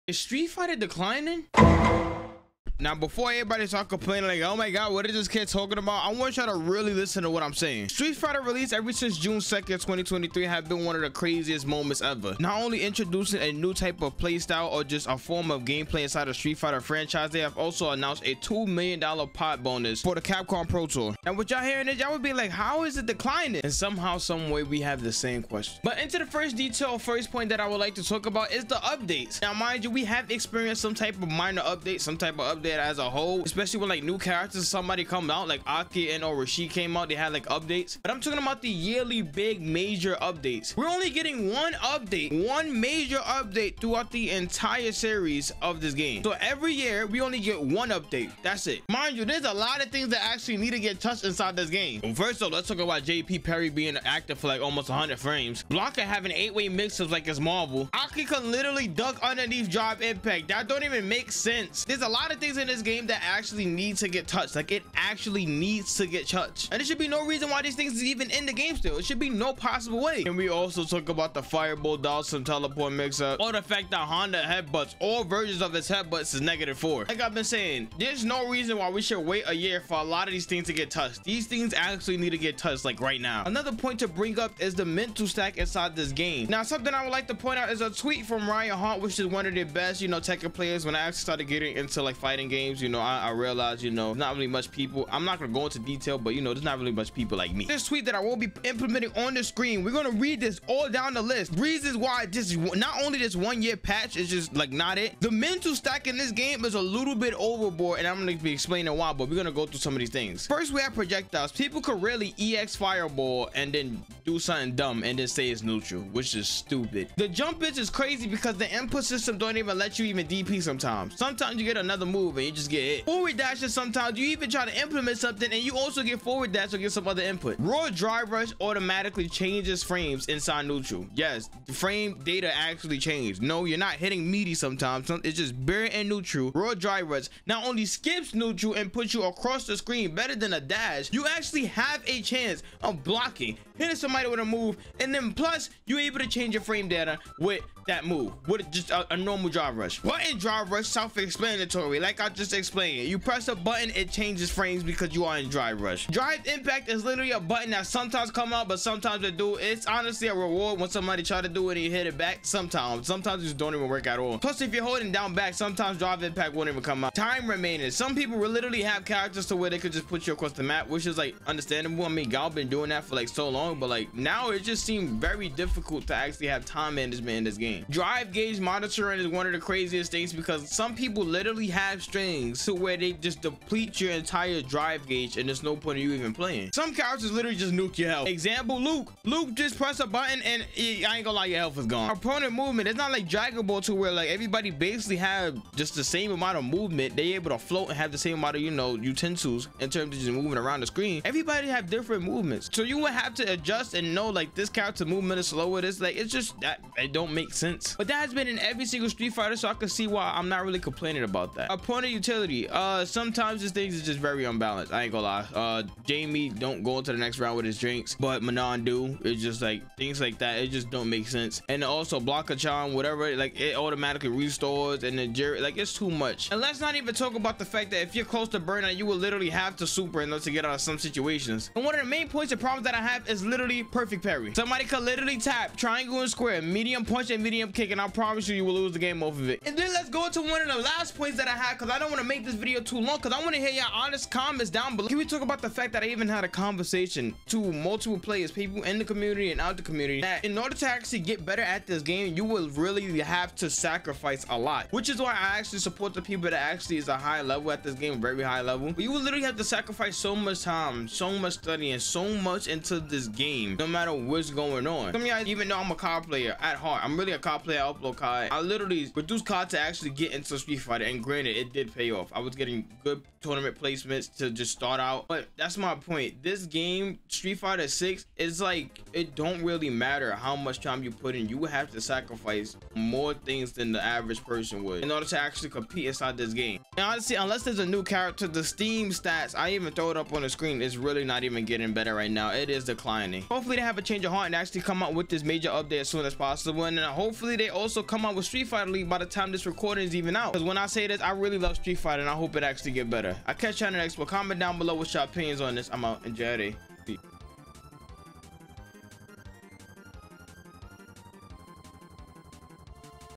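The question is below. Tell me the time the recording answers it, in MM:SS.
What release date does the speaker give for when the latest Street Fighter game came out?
00:09.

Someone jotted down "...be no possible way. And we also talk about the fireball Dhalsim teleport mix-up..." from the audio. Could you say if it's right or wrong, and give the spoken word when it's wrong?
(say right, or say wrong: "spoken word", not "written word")
right.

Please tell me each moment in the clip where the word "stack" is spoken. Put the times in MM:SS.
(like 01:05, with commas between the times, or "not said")
01:25, 01:45.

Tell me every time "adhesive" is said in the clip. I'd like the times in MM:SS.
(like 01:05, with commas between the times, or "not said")
not said.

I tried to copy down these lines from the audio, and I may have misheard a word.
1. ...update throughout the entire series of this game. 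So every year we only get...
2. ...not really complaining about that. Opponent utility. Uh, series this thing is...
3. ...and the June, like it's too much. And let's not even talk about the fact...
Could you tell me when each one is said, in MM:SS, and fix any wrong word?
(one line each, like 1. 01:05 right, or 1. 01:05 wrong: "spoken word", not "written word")
1. 00:43 right
2. 03:30 wrong: "sometimes", not "series"
3. 03:45 wrong: "Juri", not "June".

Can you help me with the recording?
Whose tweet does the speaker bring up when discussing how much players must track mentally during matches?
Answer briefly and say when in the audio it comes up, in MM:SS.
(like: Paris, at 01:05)
Ryan Hart, at 01:28.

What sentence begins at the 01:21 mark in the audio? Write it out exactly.
These things actually need to get touched like right now.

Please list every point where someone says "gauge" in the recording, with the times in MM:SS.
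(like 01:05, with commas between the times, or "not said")
02:58, 03:05.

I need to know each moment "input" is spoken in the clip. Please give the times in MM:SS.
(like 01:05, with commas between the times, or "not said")
01:58, 02:07.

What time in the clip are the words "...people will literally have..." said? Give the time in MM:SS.
02:48.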